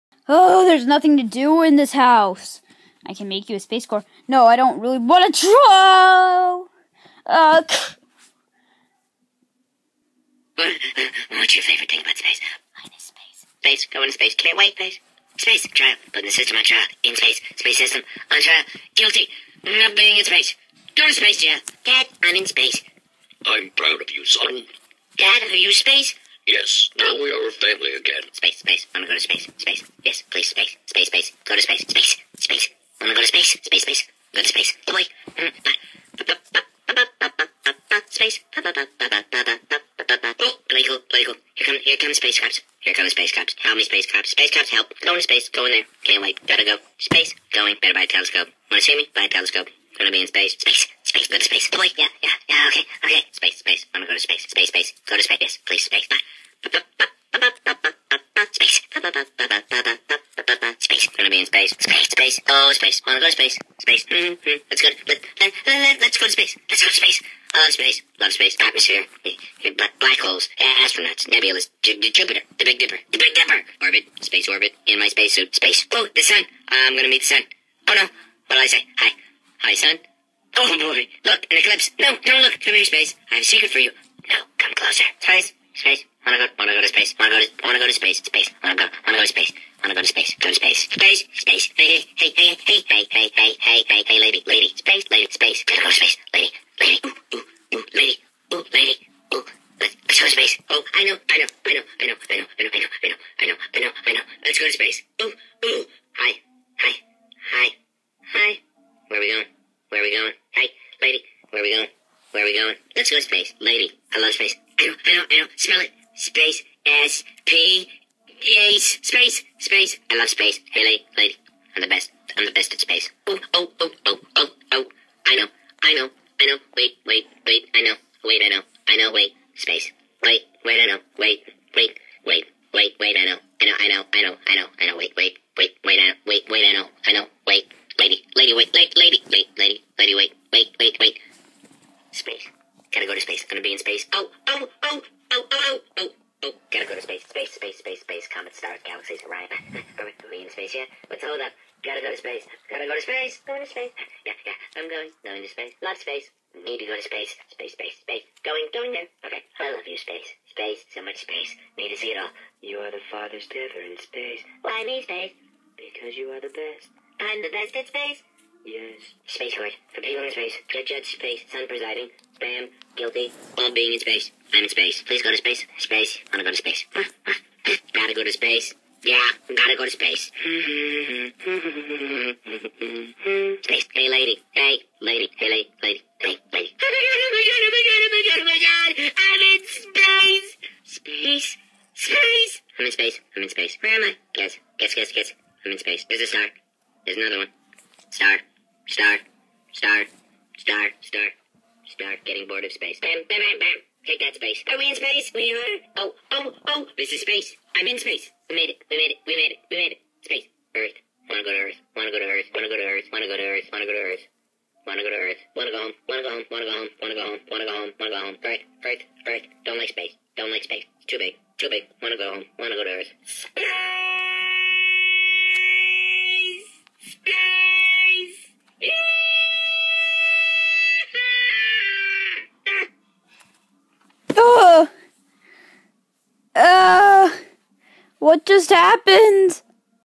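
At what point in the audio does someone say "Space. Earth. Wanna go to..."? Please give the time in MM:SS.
03:30.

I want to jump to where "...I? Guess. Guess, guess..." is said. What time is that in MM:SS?
03:14.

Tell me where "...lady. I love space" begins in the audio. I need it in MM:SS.
01:53.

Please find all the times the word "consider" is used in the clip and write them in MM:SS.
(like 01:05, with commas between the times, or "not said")
not said.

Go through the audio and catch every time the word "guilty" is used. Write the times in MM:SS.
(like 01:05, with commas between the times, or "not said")
00:18, 02:52.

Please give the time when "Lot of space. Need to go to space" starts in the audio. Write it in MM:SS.
02:35.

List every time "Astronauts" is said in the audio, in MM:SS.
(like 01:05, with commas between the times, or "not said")
01:10.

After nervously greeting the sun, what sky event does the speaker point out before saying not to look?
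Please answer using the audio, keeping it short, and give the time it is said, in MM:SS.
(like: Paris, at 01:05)
An eclipse, at 01:21.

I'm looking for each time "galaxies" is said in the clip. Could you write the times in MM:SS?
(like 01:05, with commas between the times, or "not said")
02:28.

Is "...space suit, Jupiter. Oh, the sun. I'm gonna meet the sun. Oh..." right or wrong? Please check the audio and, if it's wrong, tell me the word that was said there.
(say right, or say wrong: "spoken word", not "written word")
wrong: "Space", not "Jupiter".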